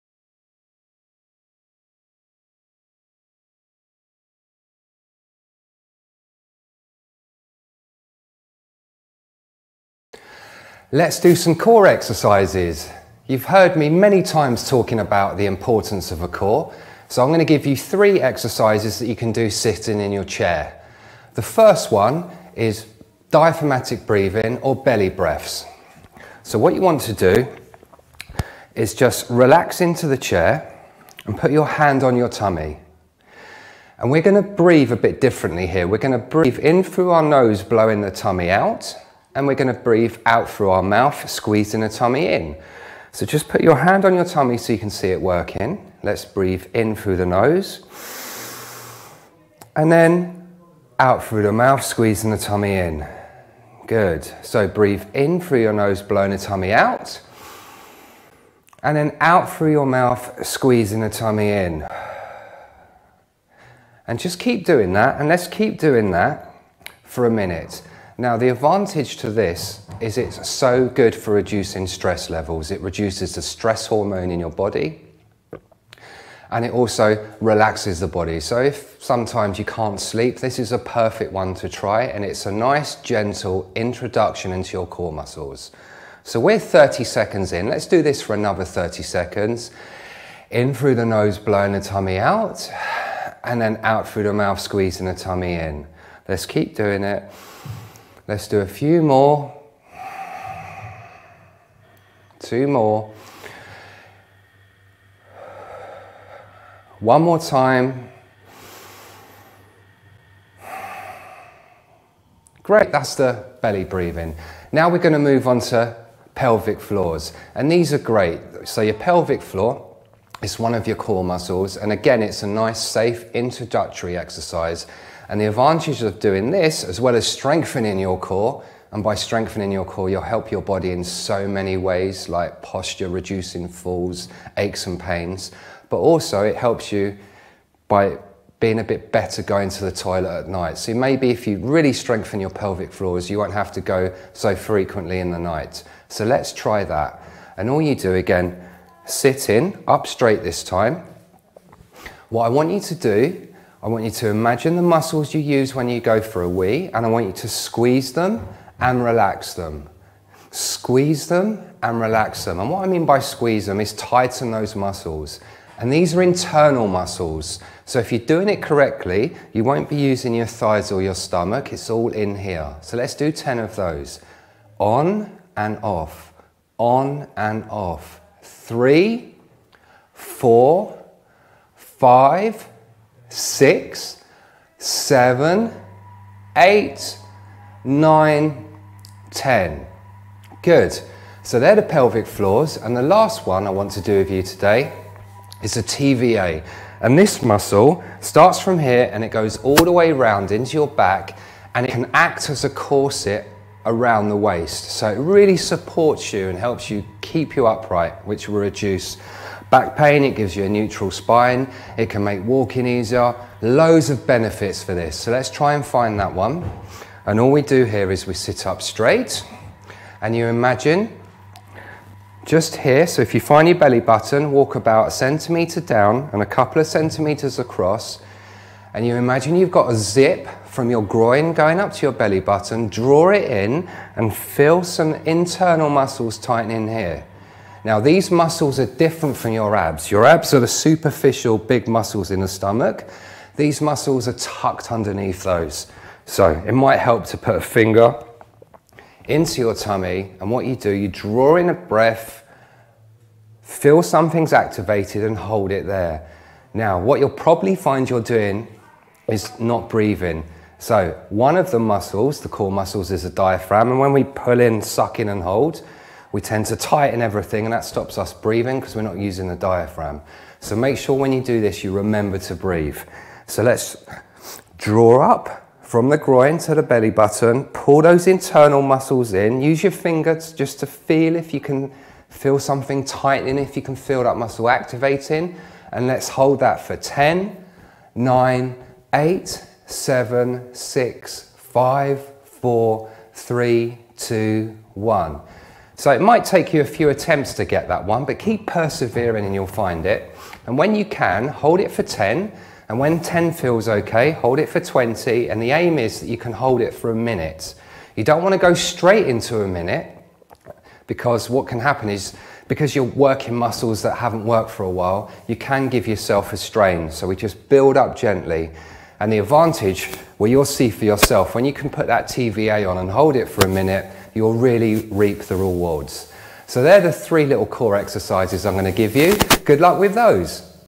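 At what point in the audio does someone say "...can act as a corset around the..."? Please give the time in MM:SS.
03:21.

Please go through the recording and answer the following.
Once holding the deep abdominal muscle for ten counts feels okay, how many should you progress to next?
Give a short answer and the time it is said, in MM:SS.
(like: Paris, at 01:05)
20, at 05:04.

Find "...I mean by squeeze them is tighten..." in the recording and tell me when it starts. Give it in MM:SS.
02:42.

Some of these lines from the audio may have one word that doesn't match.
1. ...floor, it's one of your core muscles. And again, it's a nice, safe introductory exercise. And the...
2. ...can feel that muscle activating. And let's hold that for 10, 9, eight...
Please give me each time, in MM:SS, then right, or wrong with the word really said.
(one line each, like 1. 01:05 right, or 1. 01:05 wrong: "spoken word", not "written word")
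1. 01:59 right
2. 04:43 right.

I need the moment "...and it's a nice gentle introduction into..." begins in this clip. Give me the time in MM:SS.
01:22.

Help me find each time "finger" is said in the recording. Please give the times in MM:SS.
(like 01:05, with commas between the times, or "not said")
04:07, 04:39.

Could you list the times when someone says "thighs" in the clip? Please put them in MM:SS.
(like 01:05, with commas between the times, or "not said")
02:50.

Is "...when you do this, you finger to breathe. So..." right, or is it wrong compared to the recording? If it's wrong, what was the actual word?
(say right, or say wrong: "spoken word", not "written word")
wrong: "remember", not "finger".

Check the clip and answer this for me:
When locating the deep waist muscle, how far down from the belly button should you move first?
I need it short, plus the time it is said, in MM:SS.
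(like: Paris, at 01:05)
a centimetre, at 03:45.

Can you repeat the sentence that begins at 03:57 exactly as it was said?
Now, these muscles are different from your abs.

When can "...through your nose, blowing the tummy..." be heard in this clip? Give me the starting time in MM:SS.
00:55.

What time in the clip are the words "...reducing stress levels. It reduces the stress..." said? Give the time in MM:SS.
01:11.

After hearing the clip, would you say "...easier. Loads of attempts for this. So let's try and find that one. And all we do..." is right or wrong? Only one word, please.
wrong.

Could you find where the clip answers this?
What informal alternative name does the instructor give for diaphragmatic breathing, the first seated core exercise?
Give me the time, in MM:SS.
00:24.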